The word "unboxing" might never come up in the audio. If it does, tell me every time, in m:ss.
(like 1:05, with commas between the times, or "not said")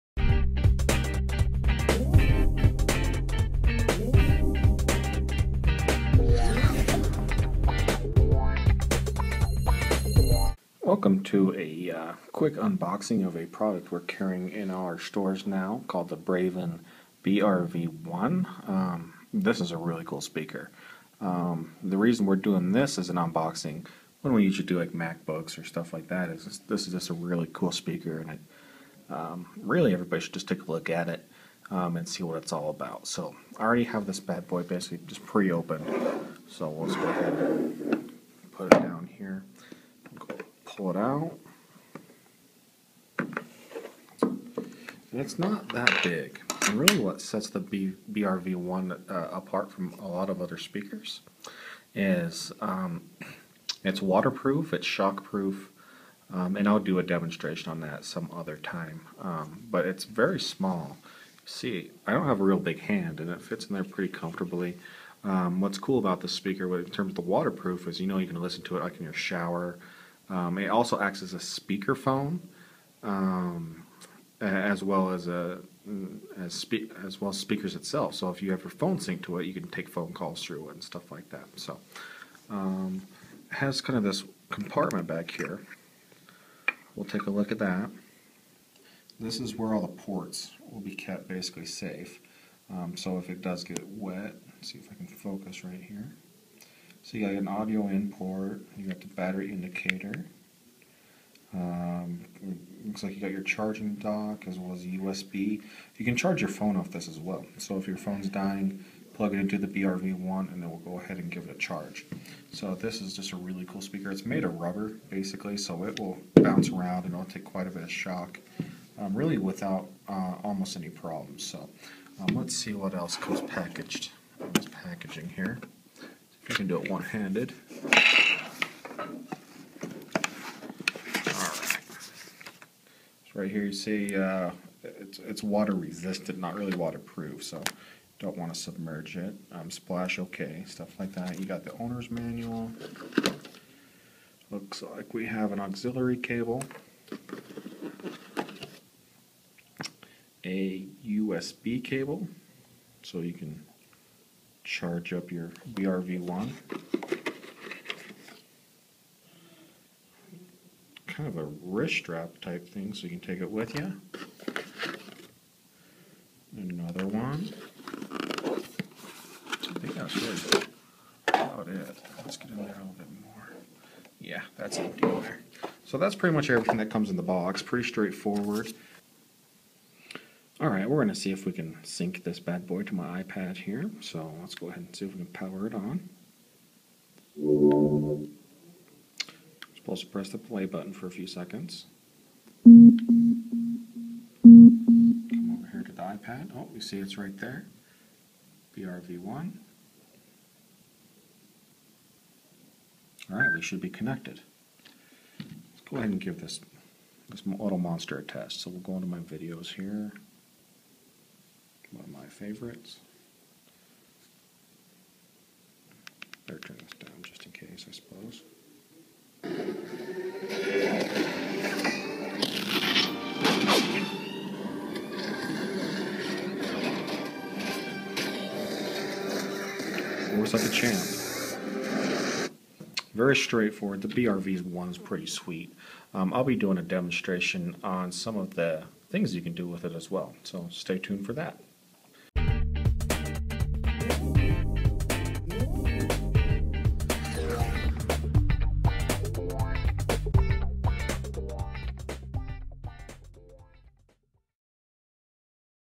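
0:12, 0:23.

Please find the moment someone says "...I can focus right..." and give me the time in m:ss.
1:34.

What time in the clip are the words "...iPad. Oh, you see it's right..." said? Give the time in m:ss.
3:16.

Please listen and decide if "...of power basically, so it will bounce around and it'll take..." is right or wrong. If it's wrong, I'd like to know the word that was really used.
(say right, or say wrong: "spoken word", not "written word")
wrong: "rubber", not "power".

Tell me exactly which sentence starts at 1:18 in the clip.
So if you have your phone synced to it, you can take phone calls through it and stuff like that.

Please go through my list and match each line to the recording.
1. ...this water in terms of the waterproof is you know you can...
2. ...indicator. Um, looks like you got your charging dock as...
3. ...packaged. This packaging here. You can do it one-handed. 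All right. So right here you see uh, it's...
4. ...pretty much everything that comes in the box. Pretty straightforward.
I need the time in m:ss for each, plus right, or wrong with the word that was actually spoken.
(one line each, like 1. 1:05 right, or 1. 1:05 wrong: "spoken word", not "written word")
1. 1:06 wrong: "speaker", not "water"
2. 1:39 right
3. 2:03 right
4. 2:56 right.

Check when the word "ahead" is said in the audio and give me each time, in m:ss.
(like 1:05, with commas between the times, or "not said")
0:37, 1:50, 3:04, 3:25.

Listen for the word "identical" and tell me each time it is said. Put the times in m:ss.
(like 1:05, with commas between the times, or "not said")
not said.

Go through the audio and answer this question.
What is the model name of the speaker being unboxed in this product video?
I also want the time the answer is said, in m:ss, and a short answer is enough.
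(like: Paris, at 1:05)
Braven BRV1, at 0:16.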